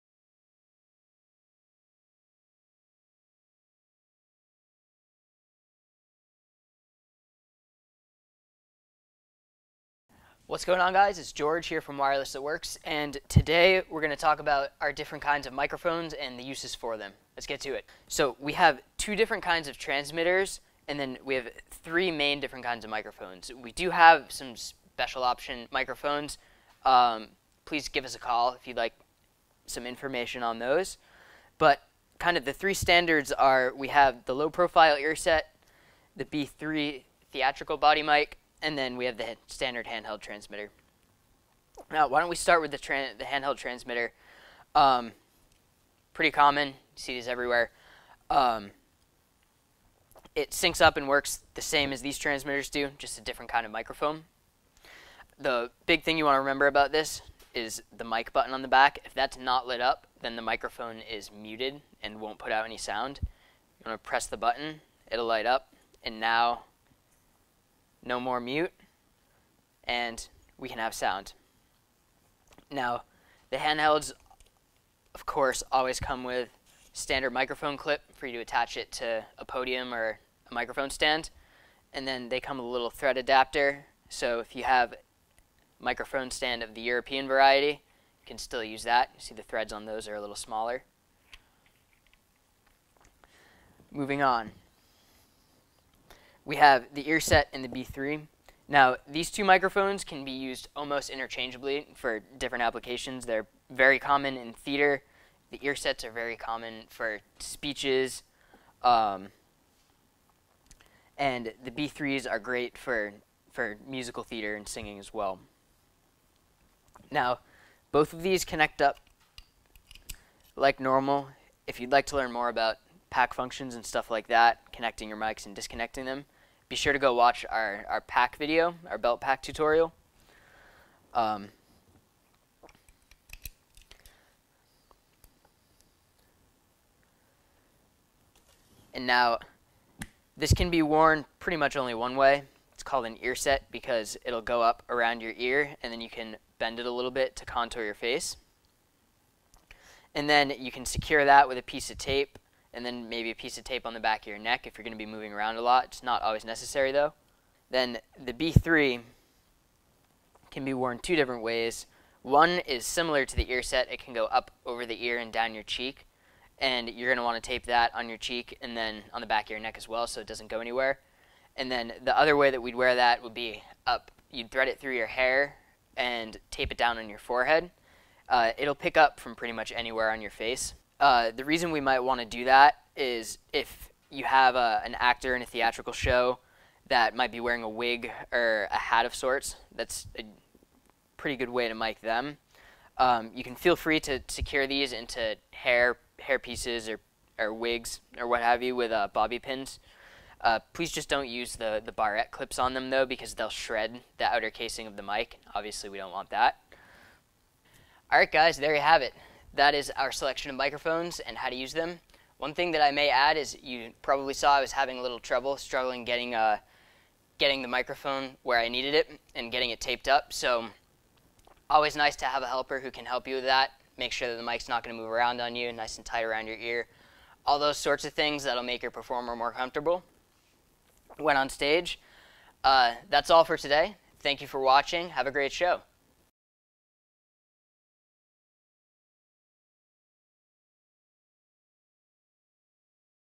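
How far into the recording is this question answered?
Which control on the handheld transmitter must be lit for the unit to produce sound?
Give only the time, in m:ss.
0:58.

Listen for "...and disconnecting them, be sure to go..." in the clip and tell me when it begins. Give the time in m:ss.
2:05.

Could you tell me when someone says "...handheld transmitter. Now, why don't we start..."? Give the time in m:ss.
0:39.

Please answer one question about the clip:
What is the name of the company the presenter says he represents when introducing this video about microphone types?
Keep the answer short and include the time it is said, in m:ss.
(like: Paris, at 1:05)
Wireless That Works, at 0:11.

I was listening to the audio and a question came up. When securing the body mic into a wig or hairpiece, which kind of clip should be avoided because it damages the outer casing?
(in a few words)
barrette clips.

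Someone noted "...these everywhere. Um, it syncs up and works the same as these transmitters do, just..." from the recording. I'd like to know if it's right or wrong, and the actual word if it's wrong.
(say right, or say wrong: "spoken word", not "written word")
right.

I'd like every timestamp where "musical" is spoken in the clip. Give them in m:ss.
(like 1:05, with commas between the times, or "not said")
1:53.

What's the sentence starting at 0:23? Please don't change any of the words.
We do have some special option microphones.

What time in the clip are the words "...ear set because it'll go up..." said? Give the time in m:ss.
2:23.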